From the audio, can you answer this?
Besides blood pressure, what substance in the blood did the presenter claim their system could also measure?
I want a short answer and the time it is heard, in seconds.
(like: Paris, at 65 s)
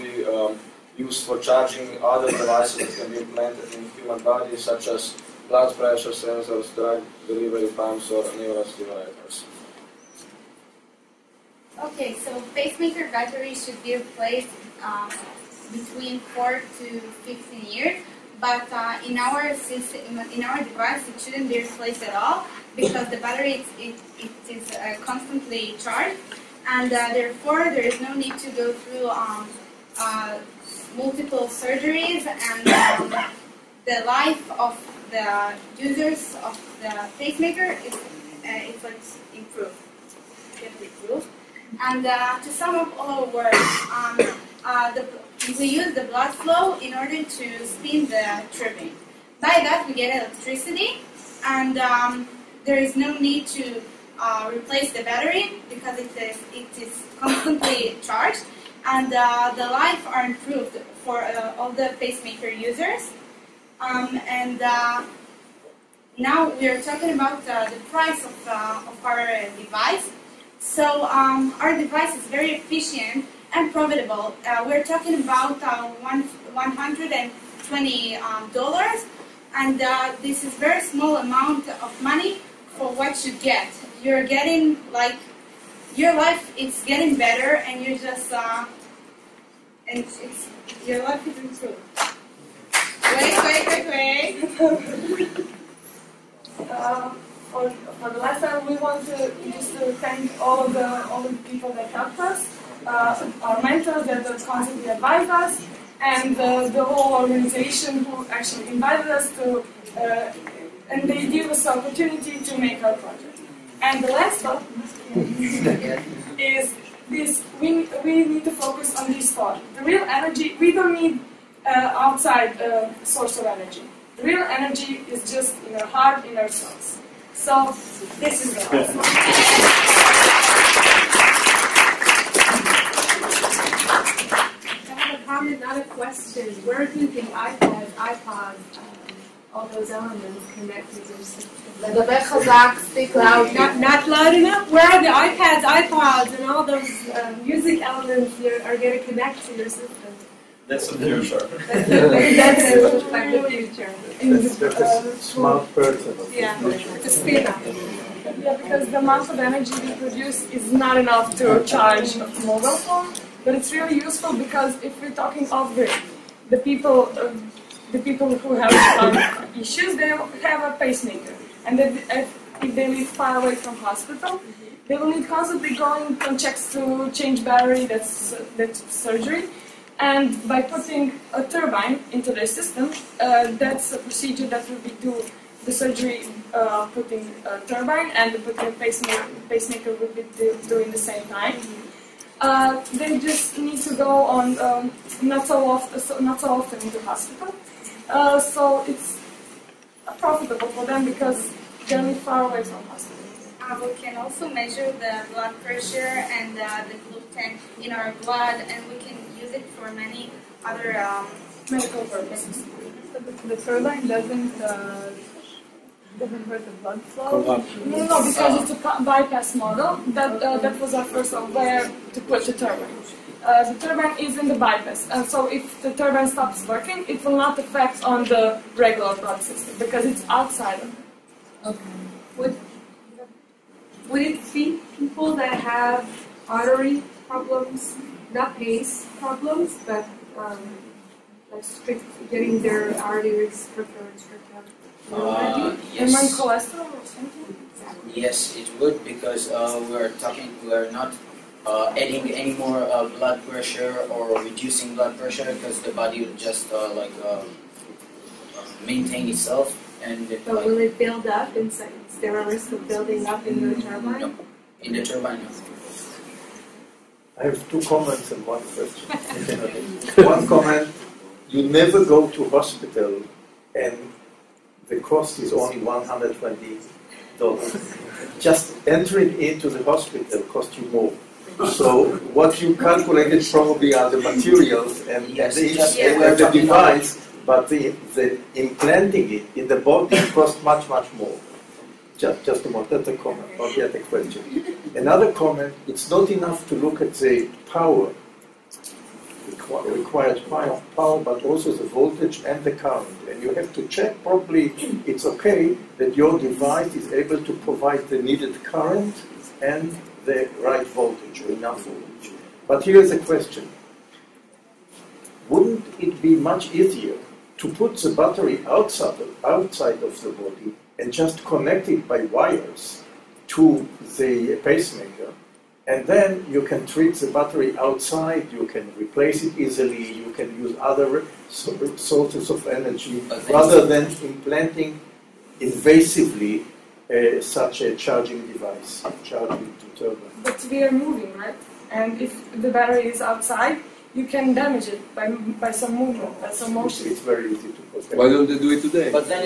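gluten, at 206 s.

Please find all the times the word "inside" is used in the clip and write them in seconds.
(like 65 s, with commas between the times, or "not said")
261 s.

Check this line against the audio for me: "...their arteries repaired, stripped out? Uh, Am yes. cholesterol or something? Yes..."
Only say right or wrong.
right.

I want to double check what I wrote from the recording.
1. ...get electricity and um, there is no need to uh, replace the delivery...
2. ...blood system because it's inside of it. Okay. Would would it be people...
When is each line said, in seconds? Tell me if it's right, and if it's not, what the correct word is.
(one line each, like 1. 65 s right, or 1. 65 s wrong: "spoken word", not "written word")
1. 49 s wrong: "battery", not "delivery"
2. 229 s wrong: "outside", not "inside".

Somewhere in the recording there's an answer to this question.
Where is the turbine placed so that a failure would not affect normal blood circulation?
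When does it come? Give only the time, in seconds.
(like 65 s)
224 s.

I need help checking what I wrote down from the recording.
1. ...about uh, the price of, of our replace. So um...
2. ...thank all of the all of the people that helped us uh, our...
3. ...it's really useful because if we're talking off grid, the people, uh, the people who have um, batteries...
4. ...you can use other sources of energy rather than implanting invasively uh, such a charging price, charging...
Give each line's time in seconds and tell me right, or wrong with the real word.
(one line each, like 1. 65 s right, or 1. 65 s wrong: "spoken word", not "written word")
1. 67 s wrong: "device", not "replace"
2. 99 s right
3. 163 s wrong: "issues", not "batteries"
4. 330 s wrong: "device", not "price".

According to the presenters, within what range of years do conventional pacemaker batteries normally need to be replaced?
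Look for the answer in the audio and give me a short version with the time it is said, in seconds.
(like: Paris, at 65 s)
4 to 15 years, at 16 s.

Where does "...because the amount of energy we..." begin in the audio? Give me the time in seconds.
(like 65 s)
158 s.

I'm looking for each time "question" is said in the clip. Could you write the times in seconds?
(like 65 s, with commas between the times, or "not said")
135 s, 268 s, 294 s, 313 s.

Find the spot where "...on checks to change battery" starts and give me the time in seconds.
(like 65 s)
176 s.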